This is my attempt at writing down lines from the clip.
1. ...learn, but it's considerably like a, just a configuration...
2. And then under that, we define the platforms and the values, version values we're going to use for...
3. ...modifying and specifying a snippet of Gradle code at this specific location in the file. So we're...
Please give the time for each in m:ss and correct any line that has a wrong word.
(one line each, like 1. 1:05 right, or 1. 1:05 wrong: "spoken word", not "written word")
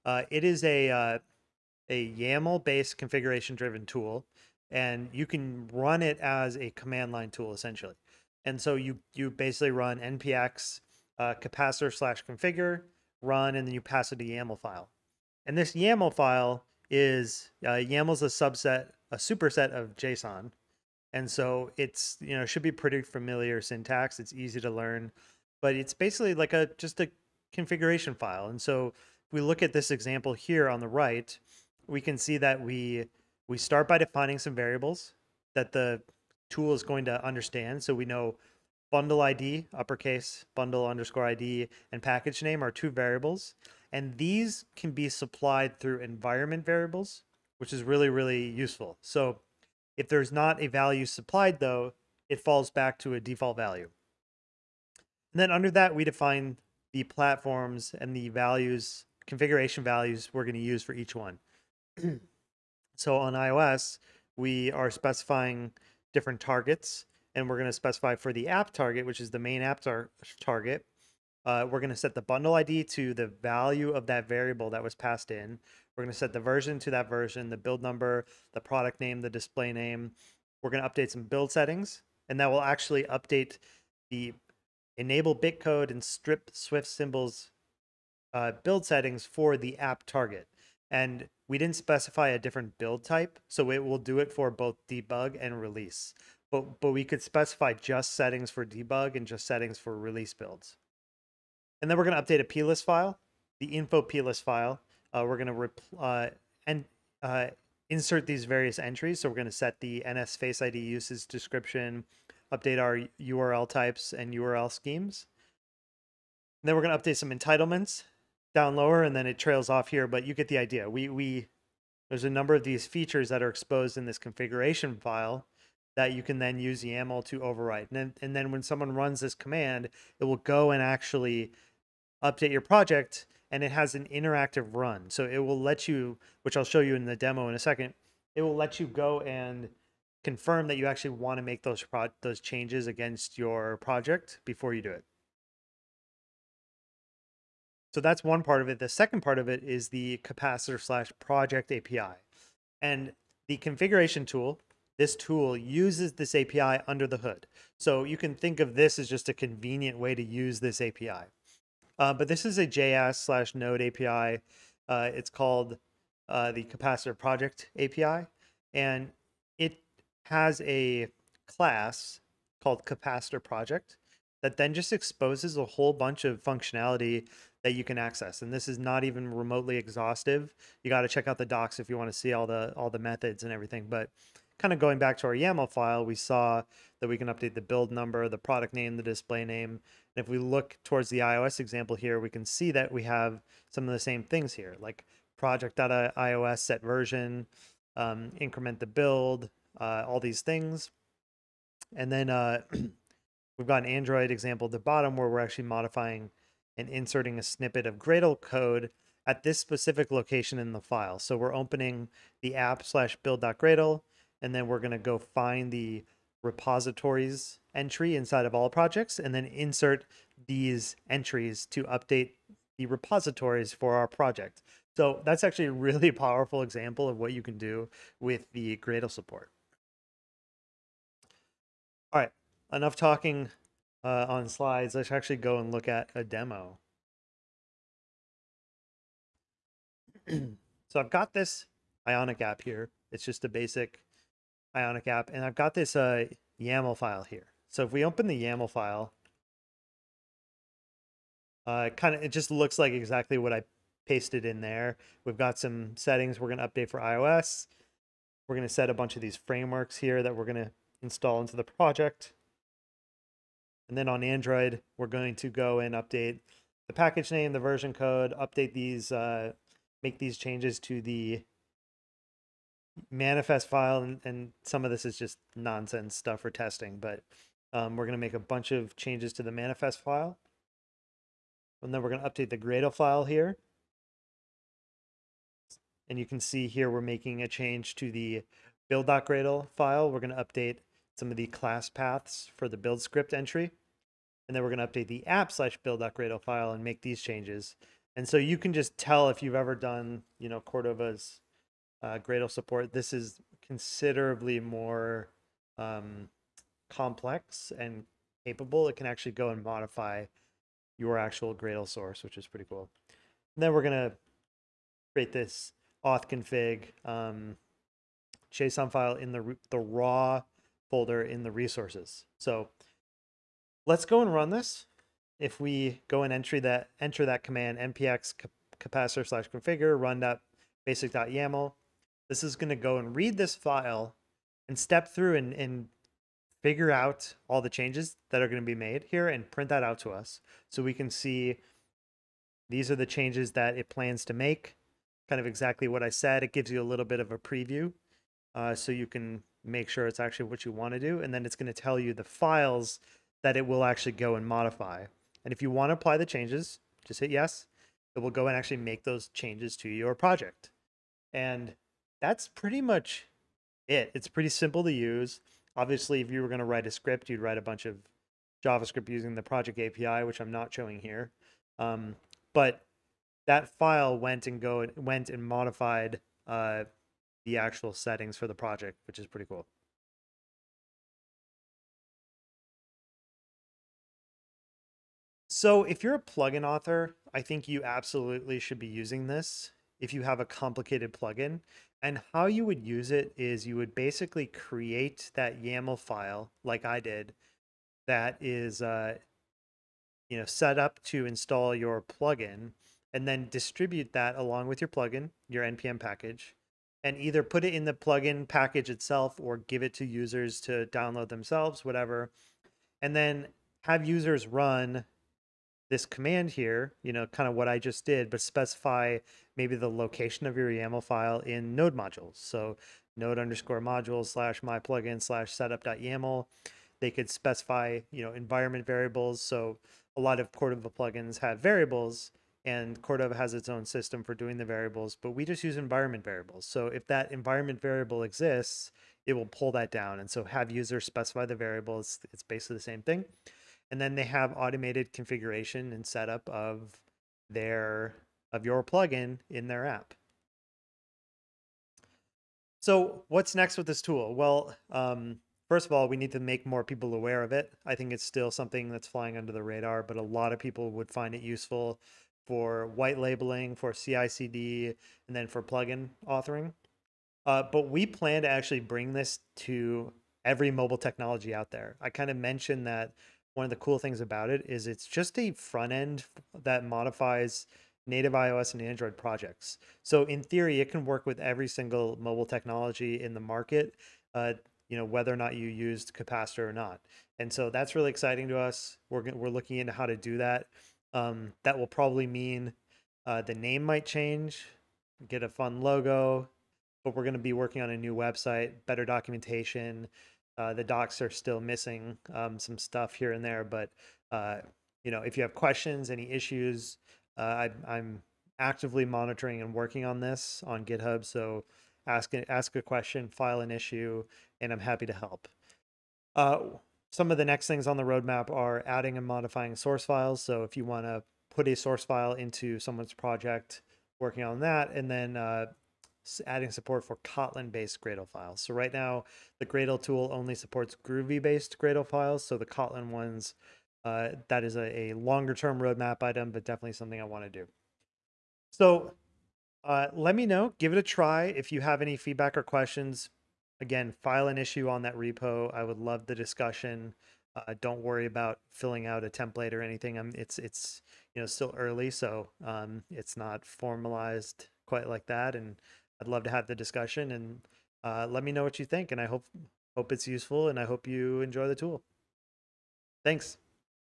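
1. 0:24 wrong: "basically", not "considerably"
2. 0:55 wrong: "configuration", not "version"
3. 3:25 wrong: "inserting", not "specifying".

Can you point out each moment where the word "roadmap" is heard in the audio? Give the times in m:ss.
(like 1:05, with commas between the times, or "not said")
8:38, 8:55.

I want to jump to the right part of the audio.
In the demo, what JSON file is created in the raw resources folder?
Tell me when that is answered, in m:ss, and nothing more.
5:16.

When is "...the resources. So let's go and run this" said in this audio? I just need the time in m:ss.
5:21.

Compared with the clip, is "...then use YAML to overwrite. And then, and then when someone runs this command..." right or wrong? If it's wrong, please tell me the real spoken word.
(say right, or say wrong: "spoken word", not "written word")
right.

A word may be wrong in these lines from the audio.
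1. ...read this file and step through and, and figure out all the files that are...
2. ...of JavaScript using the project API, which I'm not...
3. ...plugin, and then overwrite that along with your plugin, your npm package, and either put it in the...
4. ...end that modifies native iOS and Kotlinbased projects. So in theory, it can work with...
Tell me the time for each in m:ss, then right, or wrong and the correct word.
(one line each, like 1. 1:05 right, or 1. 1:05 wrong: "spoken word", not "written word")
1. 5:33 wrong: "changes", not "files"
2. 6:07 right
3. 6:42 wrong: "distribute", not "overwrite"
4. 7:55 wrong: "Android", not "Kotlinbased".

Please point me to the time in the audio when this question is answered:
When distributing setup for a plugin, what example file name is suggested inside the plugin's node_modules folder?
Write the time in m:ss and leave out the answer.
7:05.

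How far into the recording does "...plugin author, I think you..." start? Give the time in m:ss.
6:26.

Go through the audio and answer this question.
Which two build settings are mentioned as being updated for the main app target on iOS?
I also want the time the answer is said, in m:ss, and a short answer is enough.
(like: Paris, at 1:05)
Enable bitcode and strip Swift symbols, at 1:24.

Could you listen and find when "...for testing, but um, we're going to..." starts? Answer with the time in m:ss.
4:36.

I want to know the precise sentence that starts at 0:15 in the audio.
And this YAML file is uh, YAML's a subset, a superset of JSON.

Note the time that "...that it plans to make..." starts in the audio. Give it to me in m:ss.
5:43.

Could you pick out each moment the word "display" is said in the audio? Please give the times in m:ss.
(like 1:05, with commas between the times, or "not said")
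1:19, 3:09.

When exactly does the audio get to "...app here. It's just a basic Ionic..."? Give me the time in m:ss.
4:02.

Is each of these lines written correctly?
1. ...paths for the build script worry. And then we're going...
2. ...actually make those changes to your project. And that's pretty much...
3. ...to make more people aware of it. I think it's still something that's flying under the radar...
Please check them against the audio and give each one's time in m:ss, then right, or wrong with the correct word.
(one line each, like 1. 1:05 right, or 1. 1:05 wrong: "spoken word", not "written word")
1. 4:51 wrong: "entry", not "worry"
2. 5:58 right
3. 7:36 right.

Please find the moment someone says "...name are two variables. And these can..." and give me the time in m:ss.
0:42.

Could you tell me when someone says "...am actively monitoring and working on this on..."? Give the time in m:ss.
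8:27.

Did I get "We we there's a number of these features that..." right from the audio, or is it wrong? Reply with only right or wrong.
right.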